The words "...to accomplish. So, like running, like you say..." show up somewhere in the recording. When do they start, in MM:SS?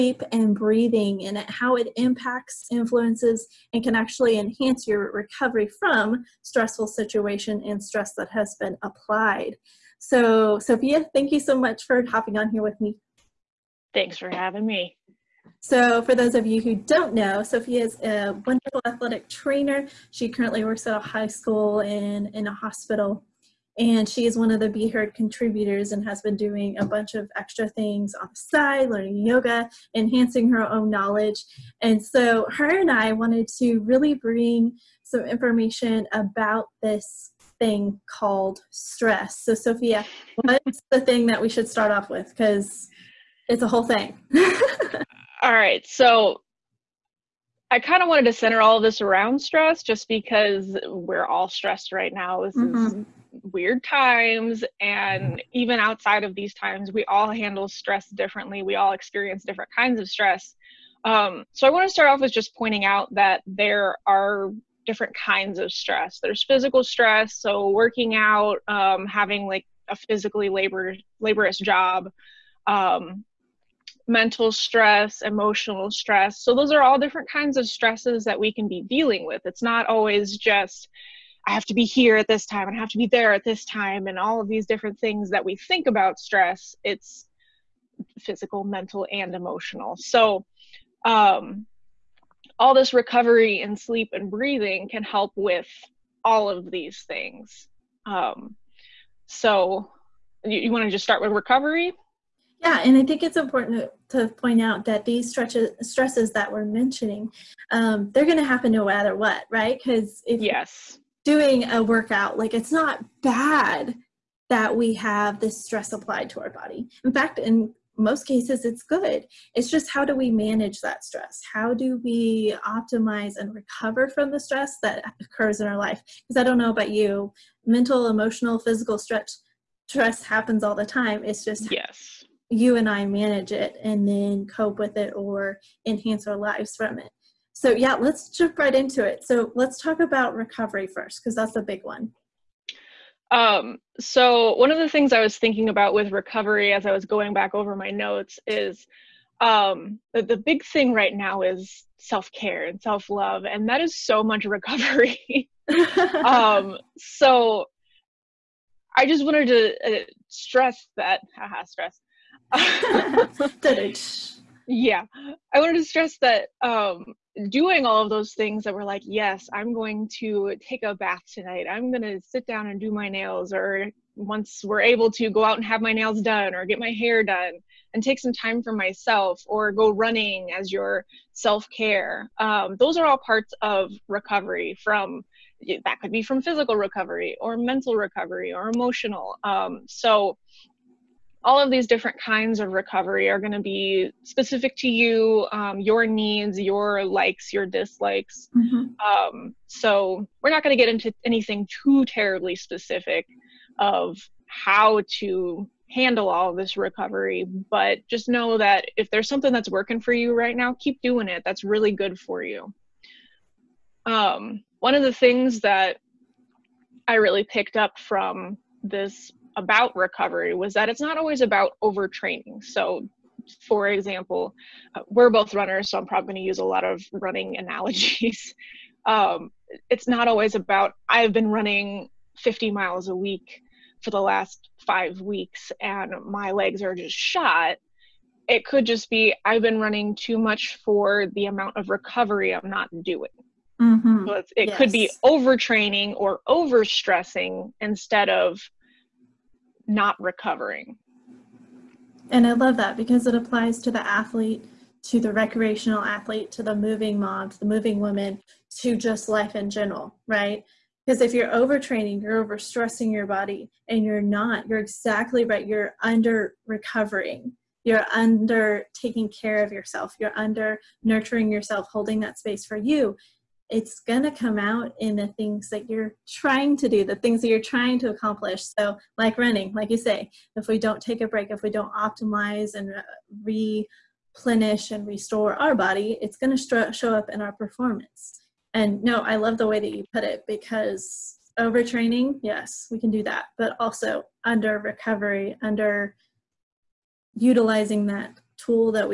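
04:37.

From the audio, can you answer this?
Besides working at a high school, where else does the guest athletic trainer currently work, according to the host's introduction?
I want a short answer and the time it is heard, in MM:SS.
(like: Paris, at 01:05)
A hospital, at 00:22.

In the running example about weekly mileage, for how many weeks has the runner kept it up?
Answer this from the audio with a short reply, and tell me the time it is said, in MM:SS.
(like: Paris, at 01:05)
5, at 03:54.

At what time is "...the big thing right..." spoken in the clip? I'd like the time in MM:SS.
02:30.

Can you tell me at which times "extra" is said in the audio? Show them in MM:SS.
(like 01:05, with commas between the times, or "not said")
00:27.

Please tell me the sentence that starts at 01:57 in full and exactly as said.
In fact, in most cases, it's good.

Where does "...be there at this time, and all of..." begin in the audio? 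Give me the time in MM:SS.
01:22.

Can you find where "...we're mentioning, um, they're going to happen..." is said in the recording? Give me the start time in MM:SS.
01:46.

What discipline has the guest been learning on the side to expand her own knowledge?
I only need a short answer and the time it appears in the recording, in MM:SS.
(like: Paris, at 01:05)
Yoga, at 00:28.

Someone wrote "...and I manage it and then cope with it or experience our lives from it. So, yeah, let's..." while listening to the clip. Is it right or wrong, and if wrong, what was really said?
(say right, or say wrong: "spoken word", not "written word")
wrong: "enhance", not "experience".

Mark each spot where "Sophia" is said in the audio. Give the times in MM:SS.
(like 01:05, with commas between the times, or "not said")
00:10, 00:17, 00:39.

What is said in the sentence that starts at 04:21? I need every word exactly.
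Because if you're overtraining, you're overstressing your body, and you're not, you're exactly right.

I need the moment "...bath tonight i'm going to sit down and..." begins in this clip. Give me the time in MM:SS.
02:50.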